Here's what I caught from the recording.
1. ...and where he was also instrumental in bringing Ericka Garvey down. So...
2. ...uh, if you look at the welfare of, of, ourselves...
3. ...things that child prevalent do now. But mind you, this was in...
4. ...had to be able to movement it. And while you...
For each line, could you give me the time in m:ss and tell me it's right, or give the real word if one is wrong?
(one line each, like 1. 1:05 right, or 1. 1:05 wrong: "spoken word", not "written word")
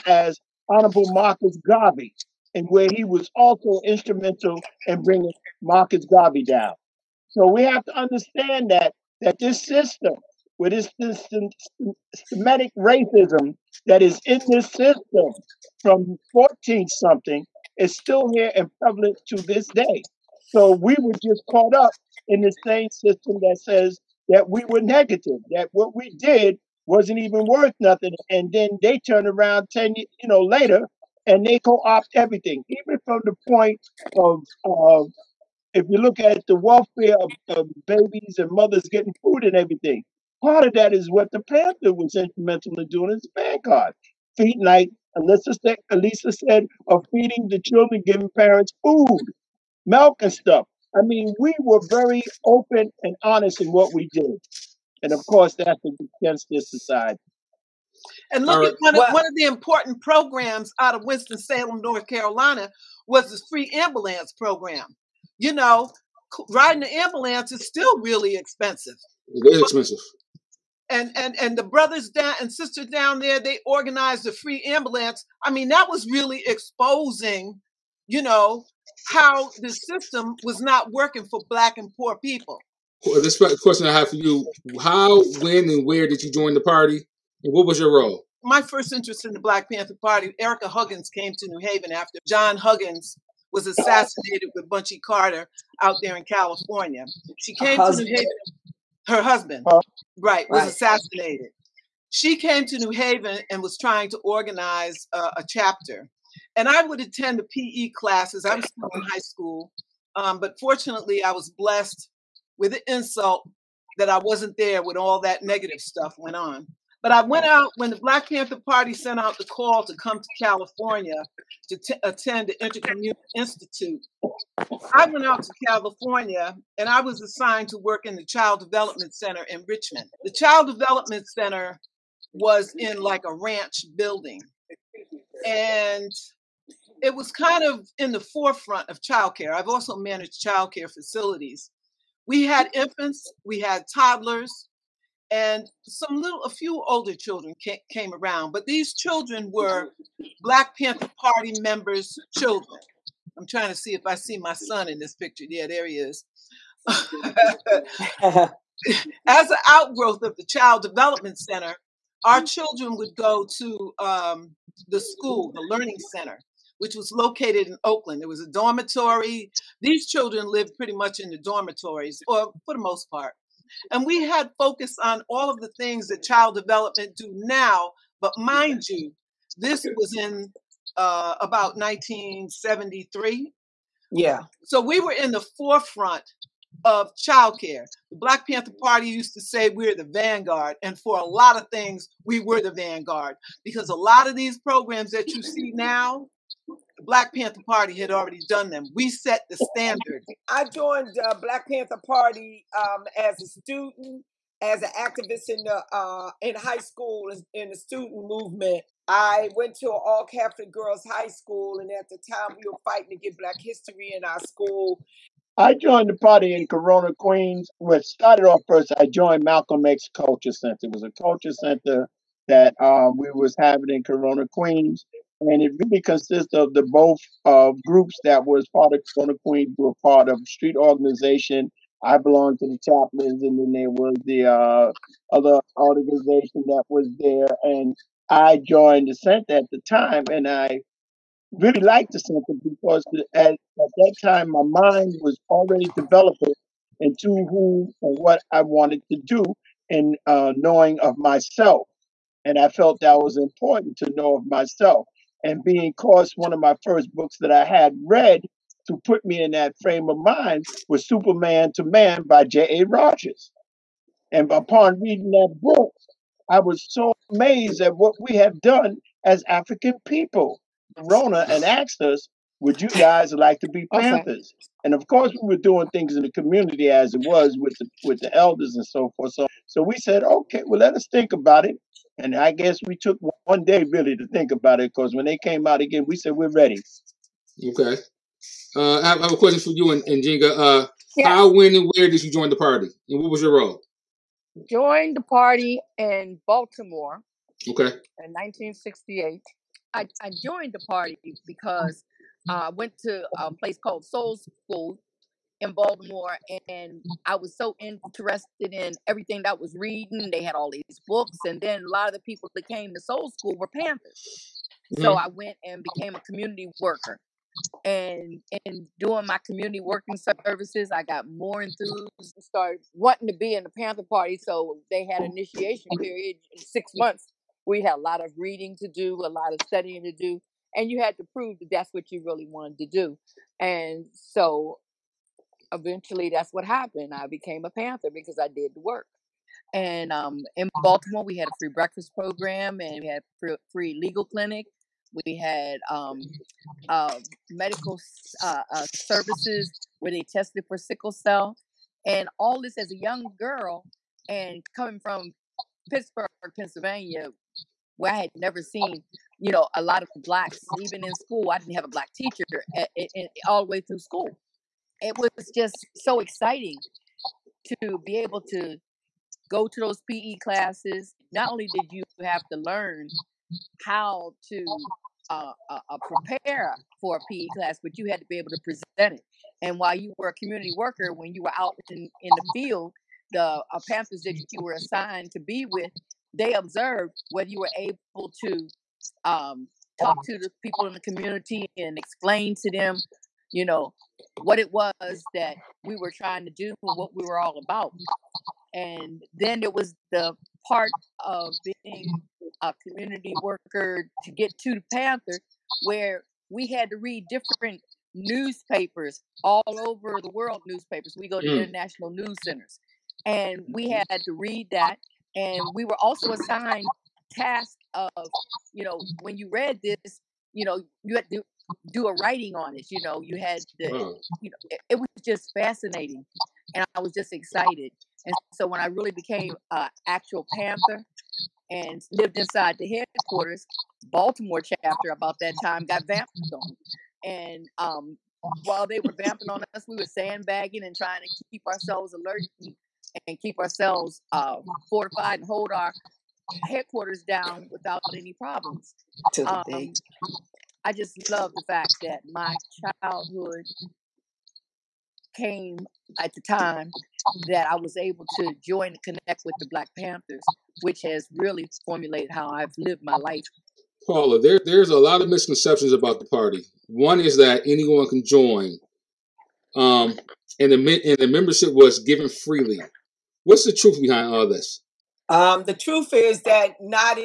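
1. 0:02 wrong: "Marcus", not "Ericka"
2. 0:34 wrong: "babies", not "ourselves"
3. 2:55 wrong: "development", not "prevalent"
4. 6:18 wrong: "present", not "movement".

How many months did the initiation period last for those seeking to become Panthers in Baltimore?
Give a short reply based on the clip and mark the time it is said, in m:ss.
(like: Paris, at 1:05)
6, at 5:26.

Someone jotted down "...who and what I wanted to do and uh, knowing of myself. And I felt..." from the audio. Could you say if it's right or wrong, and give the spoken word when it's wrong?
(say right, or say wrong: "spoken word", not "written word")
right.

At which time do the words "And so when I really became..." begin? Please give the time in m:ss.
7:08.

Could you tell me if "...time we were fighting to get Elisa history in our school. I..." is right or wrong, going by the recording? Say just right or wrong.
wrong.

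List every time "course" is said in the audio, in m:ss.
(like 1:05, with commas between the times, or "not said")
0:55, 4:15, 4:35.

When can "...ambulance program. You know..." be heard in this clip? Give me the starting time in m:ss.
1:03.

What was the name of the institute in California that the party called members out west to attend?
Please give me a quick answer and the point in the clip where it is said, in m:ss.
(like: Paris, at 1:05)
Intercommunal Institute, at 2:02.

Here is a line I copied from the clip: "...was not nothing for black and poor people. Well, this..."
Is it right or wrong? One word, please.
wrong.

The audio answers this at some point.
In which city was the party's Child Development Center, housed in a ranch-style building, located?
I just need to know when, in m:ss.
2:09.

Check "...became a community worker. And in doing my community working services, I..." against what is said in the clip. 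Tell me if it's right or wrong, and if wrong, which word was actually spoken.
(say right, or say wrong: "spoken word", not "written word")
right.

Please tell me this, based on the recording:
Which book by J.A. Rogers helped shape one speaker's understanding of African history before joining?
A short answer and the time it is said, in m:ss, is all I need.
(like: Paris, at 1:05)
Superman to Man, at 4:21.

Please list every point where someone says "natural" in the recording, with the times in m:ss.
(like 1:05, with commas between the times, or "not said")
not said.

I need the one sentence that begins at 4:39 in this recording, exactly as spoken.
So, so we said, okay, well, let us think about it.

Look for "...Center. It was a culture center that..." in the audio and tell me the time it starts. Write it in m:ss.
3:40.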